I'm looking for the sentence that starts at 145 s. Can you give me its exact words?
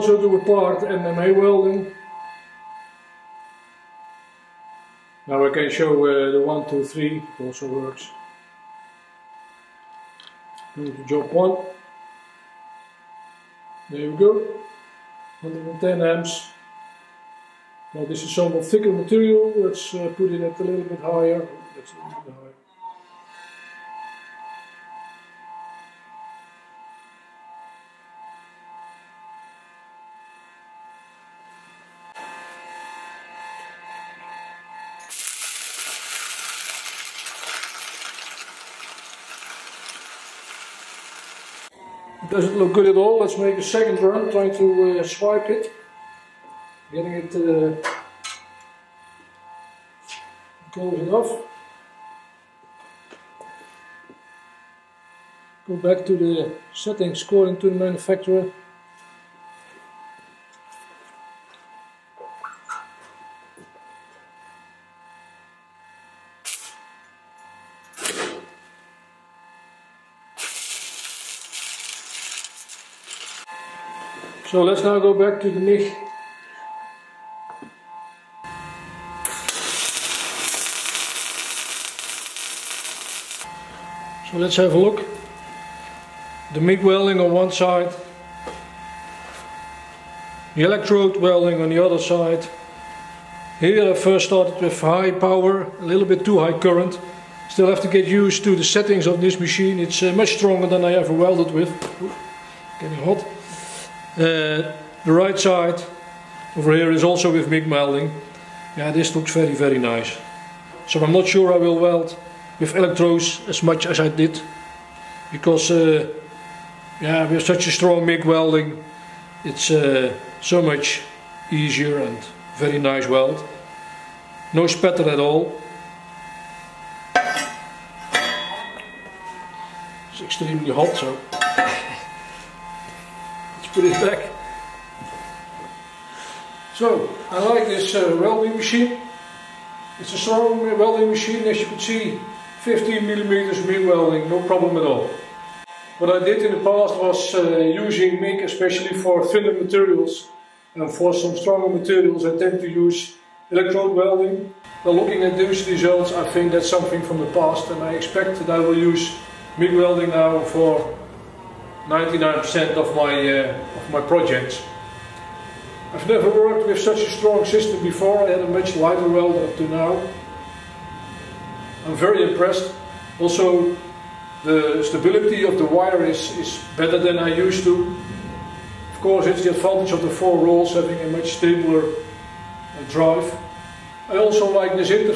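What I did in the past was uh, using MIG, especially for thinner materials.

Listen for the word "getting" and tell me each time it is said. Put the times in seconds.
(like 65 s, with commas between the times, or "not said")
46 s, 102 s.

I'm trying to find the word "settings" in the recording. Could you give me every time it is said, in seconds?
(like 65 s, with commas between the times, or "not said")
56 s, 98 s.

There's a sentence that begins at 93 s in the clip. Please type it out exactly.
Here I first started with high power, a little bit too high current.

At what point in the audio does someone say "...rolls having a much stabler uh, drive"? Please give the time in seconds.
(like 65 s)
180 s.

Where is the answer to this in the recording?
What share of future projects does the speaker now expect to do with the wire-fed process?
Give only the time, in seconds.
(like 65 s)
161 s.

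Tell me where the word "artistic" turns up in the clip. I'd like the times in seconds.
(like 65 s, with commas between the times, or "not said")
not said.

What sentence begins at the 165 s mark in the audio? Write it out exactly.
I've never worked with such a strong system before.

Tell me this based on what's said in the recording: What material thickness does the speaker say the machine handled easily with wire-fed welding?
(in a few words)
15 millimeters.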